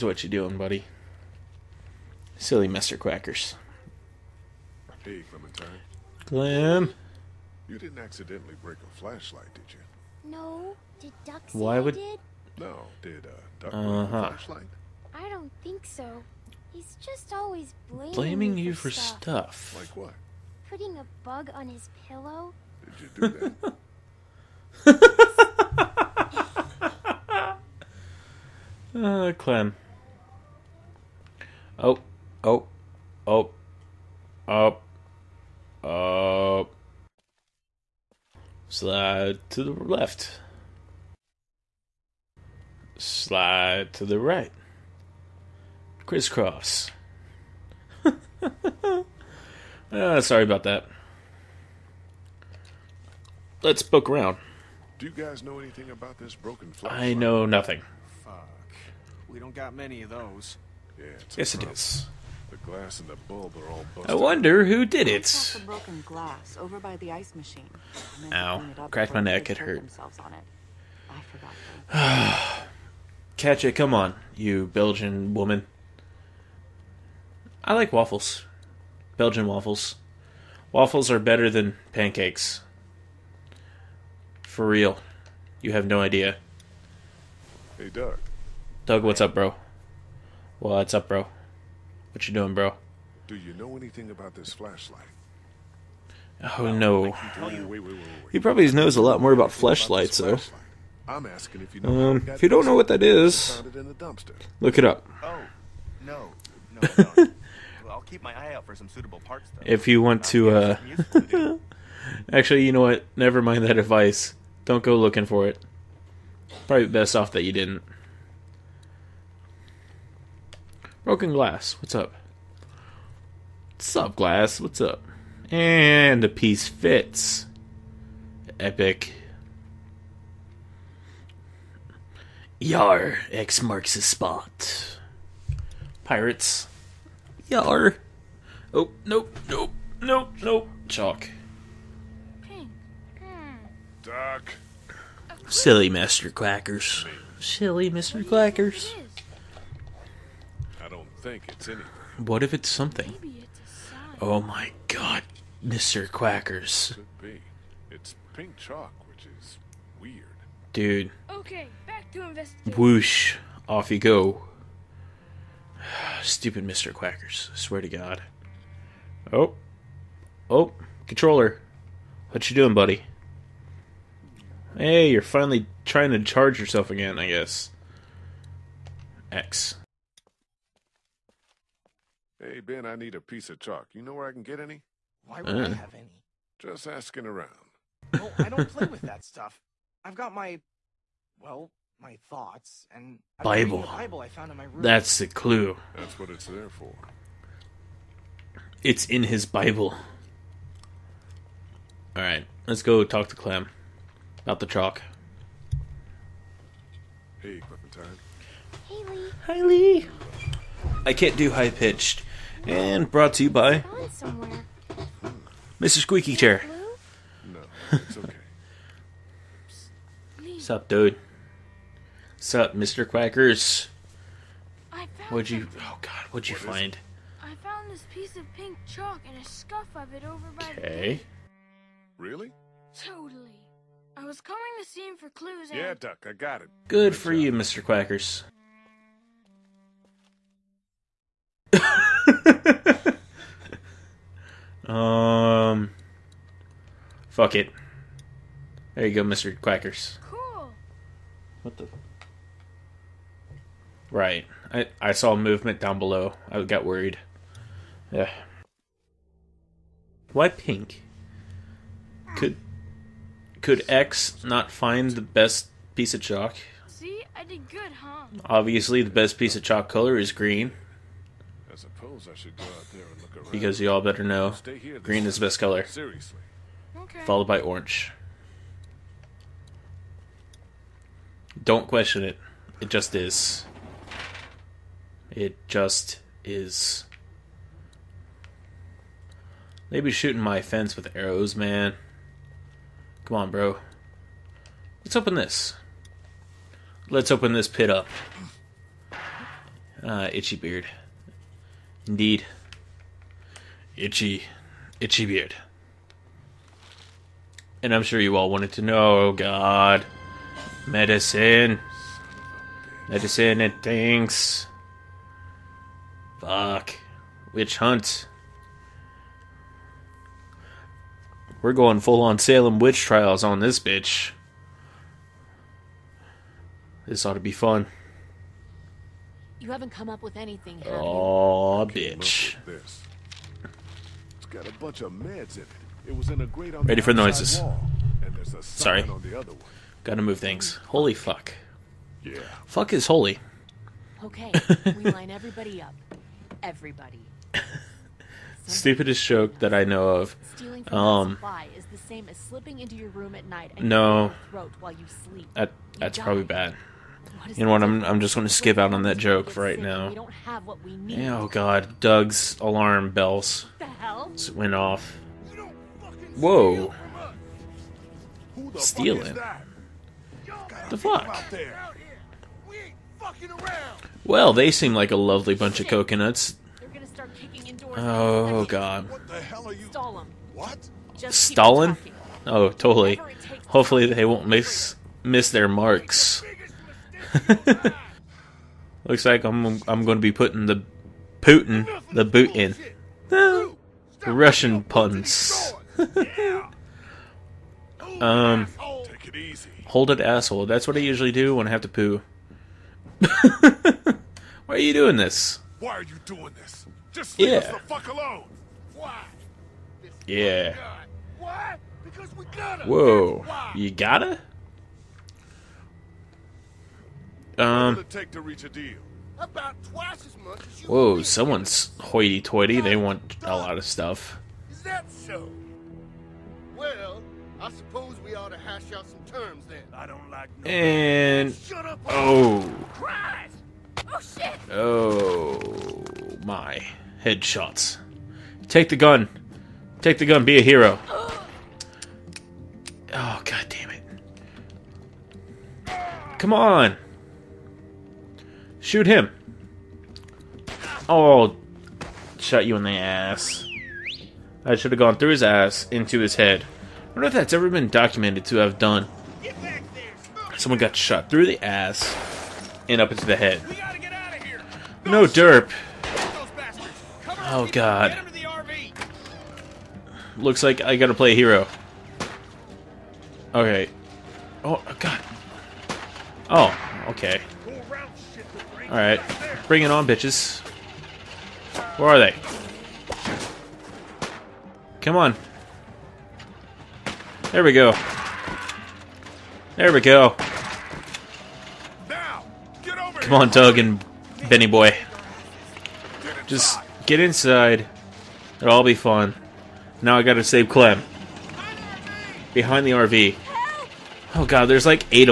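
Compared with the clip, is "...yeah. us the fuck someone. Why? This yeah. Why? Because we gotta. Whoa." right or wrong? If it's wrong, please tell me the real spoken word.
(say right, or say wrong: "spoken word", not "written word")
wrong: "alone", not "someone".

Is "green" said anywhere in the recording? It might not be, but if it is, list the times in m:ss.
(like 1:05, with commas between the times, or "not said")
4:30, 4:35.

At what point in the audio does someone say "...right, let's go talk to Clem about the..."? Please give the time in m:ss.
3:22.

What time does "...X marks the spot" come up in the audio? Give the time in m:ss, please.
2:13.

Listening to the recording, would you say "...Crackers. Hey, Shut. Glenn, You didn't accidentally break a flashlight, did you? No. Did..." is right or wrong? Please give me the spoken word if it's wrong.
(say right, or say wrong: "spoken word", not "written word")
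wrong: "Clementine", not "Shut".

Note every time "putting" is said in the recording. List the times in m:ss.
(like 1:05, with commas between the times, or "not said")
0:20, 6:30.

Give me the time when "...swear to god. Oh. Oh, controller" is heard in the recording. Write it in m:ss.
2:47.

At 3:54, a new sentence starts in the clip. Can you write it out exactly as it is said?
I was coming to see him for clues.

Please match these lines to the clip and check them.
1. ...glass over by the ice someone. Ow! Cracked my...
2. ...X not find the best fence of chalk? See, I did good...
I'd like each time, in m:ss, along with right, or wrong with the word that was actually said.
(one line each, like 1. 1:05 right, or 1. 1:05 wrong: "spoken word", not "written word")
1. 1:06 wrong: "machine", not "someone"
2. 4:23 wrong: "piece", not "fence".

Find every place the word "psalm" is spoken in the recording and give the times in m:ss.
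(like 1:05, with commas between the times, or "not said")
not said.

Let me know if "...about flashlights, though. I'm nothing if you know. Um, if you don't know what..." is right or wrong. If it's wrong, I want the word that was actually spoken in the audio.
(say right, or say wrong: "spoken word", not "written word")
wrong: "asking", not "nothing".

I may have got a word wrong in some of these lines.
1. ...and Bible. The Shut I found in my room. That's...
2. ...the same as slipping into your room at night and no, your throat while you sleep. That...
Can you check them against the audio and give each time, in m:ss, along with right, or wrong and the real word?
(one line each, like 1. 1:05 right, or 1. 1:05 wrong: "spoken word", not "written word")
1. 3:12 wrong: "Bible", not "Shut"
2. 5:51 right.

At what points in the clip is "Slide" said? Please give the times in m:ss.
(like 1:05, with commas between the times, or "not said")
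0:38, 0:42.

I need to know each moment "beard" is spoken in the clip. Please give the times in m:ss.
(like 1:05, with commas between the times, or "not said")
5:00, 5:05.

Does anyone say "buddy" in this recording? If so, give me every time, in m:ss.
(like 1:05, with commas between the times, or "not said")
0:00, 2:52.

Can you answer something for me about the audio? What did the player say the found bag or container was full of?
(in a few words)
meds.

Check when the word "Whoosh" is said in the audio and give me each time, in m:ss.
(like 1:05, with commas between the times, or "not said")
2:42.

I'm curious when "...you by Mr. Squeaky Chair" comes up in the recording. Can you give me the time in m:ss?
3:33.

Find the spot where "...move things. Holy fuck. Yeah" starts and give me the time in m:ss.
5:40.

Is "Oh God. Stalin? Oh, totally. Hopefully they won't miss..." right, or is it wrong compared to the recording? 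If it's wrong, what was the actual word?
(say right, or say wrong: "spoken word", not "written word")
right.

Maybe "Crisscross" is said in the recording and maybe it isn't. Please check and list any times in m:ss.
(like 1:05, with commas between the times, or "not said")
0:46.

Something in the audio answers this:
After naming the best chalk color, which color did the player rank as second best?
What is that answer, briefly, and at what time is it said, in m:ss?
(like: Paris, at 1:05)
orange, at 4:37.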